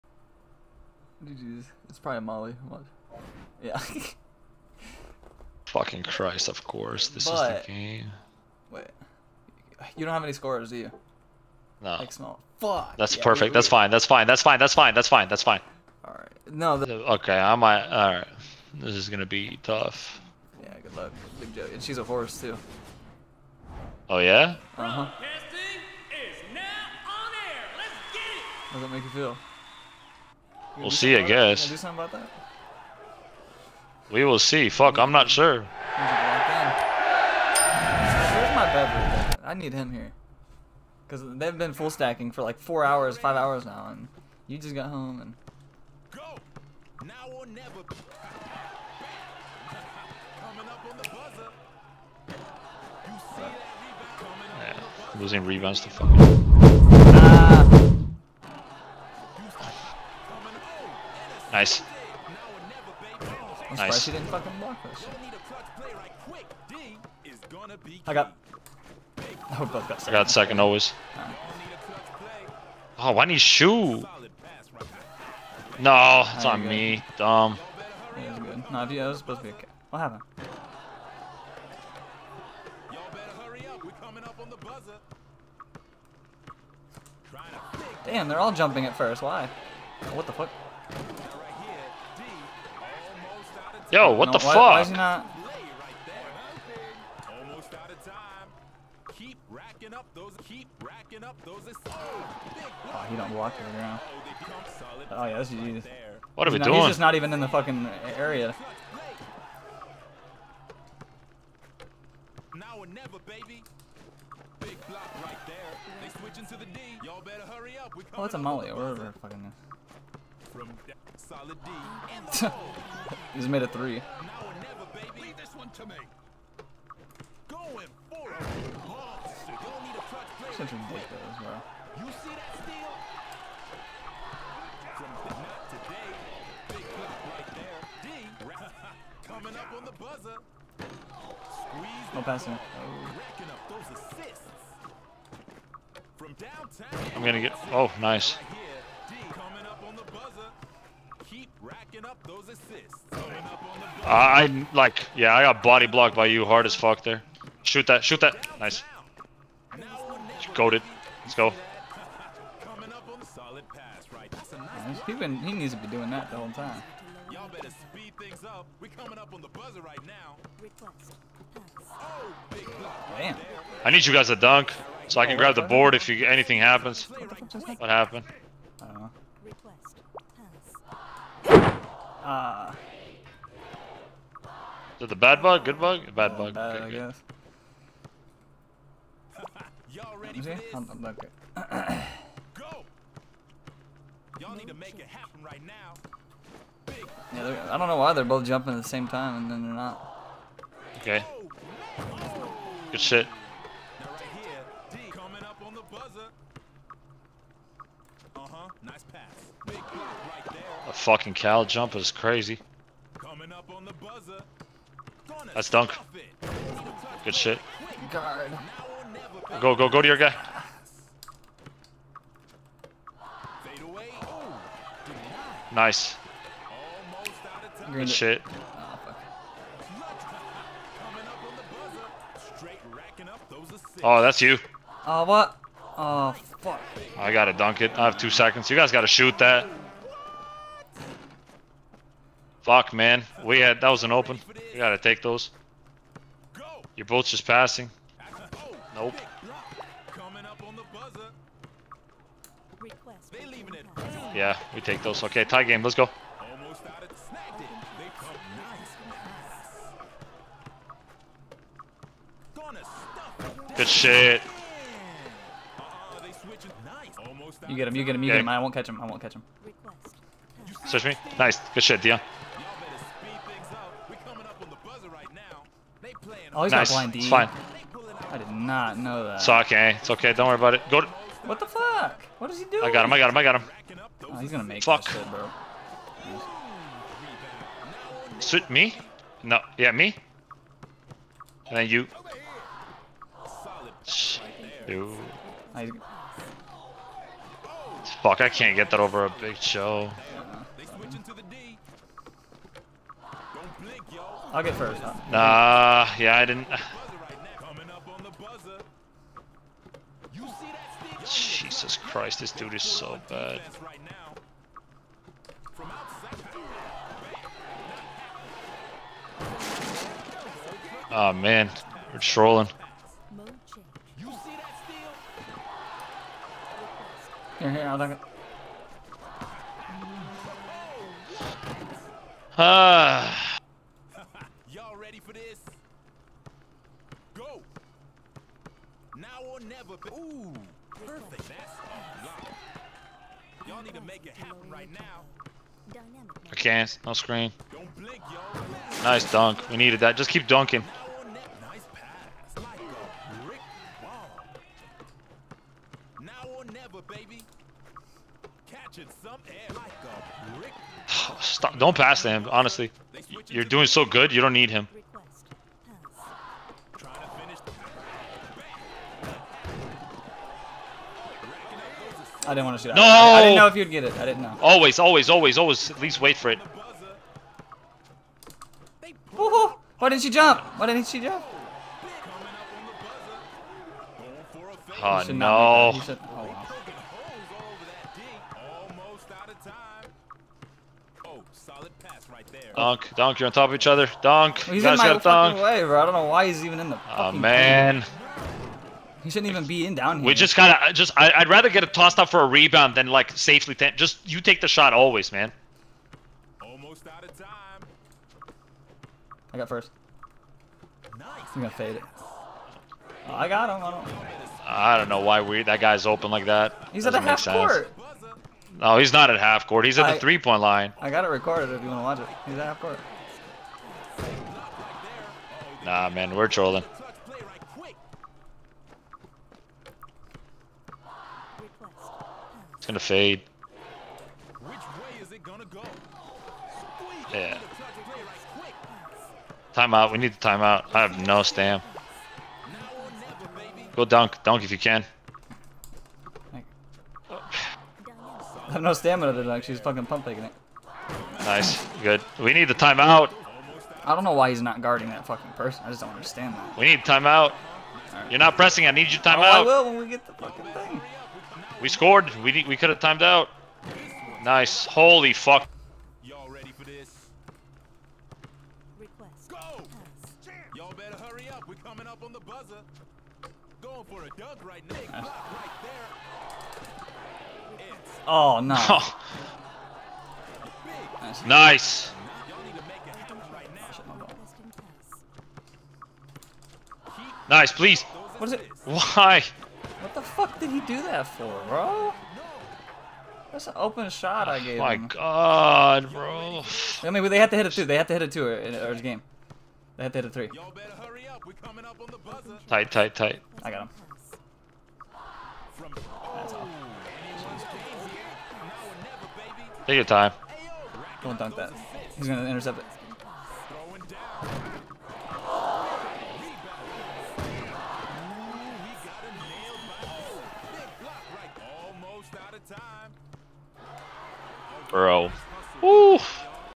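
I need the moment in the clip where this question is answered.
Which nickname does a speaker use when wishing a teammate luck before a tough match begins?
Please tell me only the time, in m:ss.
0:21.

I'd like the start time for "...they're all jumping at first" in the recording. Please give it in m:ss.
1:28.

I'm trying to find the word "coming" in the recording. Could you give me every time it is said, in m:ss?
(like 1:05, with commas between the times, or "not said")
0:47, 2:19, 2:48, 3:25, 7:51.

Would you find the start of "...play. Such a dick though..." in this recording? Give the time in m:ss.
2:10.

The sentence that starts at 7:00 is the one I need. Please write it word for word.
I got it recorded if you want to watch it.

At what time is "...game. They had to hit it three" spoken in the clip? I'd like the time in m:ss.
8:19.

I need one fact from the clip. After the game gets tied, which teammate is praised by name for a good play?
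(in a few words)
Deion.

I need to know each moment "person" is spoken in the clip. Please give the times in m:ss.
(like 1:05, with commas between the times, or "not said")
7:35.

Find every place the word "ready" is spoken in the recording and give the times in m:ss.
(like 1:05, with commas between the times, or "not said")
3:10, 7:46.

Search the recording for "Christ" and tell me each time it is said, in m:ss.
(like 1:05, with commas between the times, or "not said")
0:06, 5:11.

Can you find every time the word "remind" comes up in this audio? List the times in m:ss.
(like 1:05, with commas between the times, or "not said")
not said.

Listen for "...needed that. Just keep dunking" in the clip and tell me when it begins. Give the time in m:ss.
5:49.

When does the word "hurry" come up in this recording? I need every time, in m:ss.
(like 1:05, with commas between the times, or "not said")
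1:57, 7:51.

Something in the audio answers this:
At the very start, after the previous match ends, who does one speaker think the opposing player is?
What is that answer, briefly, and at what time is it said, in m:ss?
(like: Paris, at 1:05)
Molly, at 0:02.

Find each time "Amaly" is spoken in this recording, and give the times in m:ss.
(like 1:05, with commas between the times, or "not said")
1:58.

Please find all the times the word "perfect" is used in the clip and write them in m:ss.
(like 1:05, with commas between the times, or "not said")
0:13, 5:40.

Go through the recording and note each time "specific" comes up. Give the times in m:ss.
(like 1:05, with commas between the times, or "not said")
not said.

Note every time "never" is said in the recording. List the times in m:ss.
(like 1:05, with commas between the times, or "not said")
0:47, 1:52, 2:04, 5:39, 5:56.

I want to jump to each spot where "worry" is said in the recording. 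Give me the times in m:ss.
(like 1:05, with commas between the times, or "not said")
4:40.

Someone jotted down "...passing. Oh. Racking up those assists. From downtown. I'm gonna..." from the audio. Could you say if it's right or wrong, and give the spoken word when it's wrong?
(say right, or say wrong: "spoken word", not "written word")
right.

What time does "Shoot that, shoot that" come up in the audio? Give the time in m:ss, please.
2:37.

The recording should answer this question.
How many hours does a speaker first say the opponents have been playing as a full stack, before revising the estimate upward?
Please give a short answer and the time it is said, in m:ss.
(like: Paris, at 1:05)
4 hours, at 0:42.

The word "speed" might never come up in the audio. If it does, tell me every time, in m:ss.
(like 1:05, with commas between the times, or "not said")
2:47.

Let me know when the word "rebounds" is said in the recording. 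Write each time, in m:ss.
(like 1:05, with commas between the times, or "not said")
0:55, 6:42.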